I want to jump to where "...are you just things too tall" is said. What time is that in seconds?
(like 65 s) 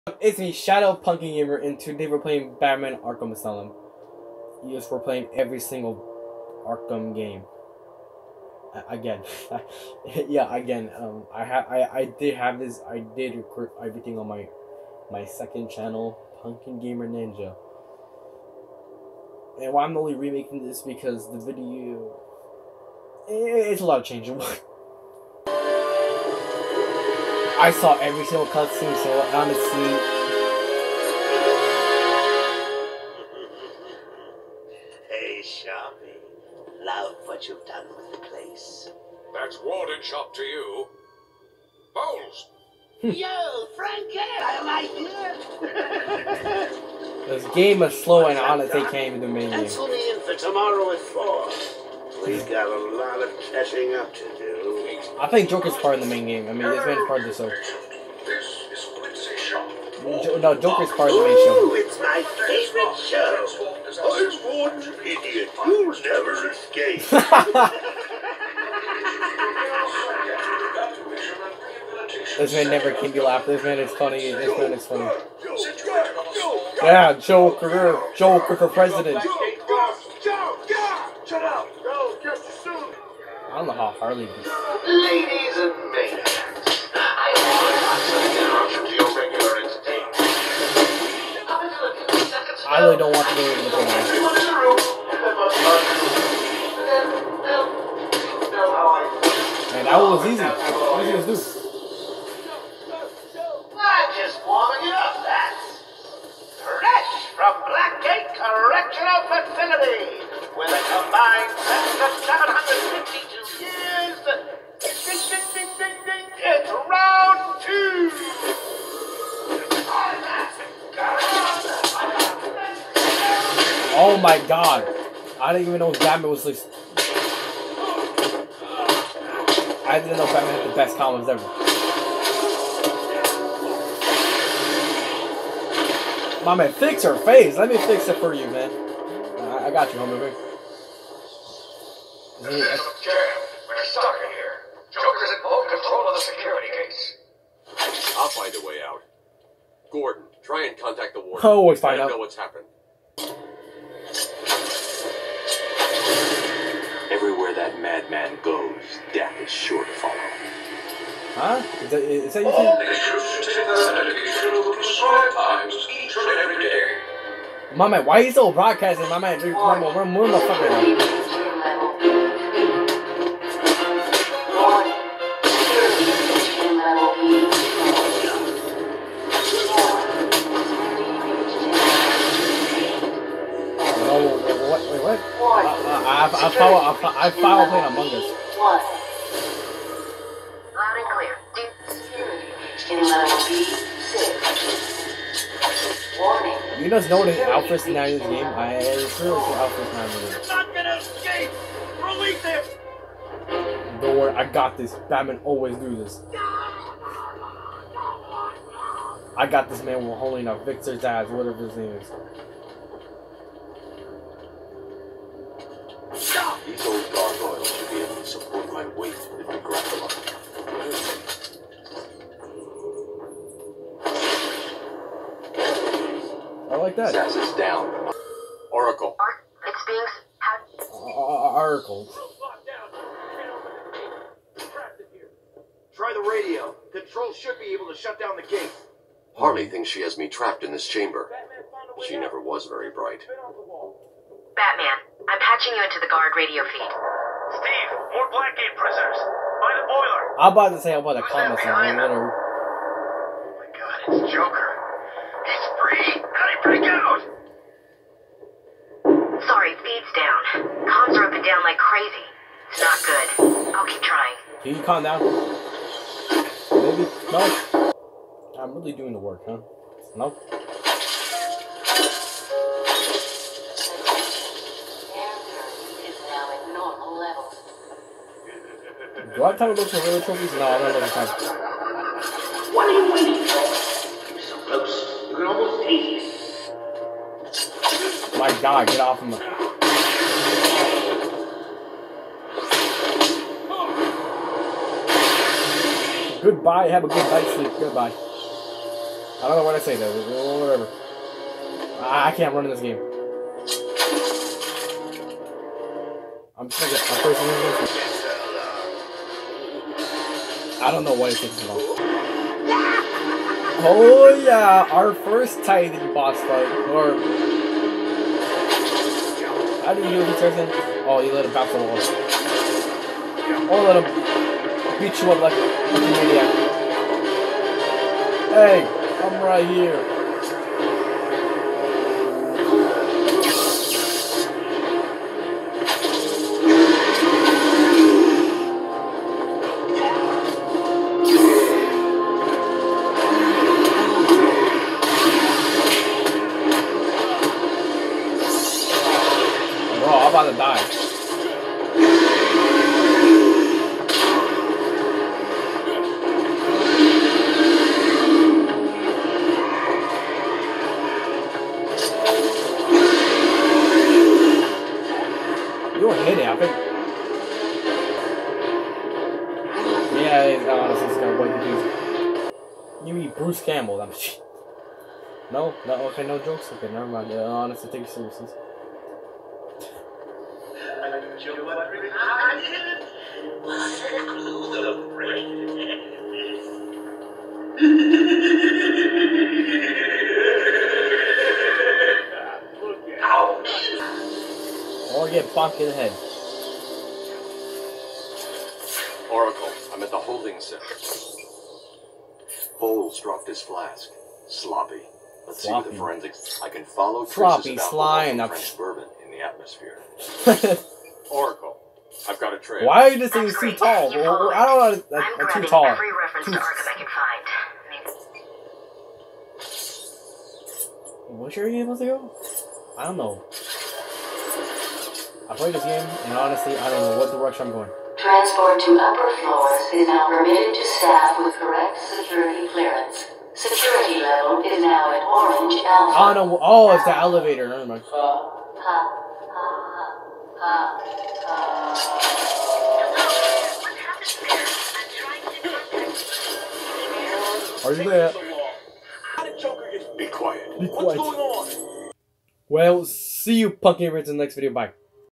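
413 s.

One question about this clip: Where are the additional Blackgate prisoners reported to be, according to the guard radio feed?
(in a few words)
By the boiler.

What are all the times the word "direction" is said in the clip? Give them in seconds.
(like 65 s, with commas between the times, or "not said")
427 s.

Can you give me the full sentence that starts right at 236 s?
Control should be able to shut down the gate.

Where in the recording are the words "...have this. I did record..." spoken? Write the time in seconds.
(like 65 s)
12 s.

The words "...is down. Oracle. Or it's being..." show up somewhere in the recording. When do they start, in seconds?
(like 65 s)
227 s.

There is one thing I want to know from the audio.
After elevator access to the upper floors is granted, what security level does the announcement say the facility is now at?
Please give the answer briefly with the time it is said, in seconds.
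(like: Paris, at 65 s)
Orange alpha, at 435 s.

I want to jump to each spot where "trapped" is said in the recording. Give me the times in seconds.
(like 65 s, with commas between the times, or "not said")
240 s.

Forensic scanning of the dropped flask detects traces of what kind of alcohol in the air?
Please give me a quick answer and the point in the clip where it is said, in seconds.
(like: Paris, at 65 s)
French bourbon, at 408 s.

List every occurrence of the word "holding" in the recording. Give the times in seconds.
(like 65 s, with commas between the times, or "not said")
210 s, 400 s.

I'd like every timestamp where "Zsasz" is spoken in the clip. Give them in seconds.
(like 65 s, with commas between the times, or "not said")
210 s, 227 s.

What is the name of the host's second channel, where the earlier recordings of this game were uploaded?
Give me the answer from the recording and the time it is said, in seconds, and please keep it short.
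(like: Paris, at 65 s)
Punkin Gamer Ninja, at 16 s.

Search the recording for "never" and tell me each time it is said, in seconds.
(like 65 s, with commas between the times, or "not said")
65 s, 72 s, 242 s, 376 s, 437 s.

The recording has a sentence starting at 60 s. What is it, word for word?
Jo no, Joker's part of the main show.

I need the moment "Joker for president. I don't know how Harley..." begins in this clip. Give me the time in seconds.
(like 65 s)
78 s.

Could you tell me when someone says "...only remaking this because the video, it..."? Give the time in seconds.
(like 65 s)
19 s.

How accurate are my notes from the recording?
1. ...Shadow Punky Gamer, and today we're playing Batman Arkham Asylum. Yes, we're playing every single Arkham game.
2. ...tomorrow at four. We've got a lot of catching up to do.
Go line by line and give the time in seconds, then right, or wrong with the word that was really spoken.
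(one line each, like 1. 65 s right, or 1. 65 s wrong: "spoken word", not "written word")
1. 0 s right
2. 50 s right.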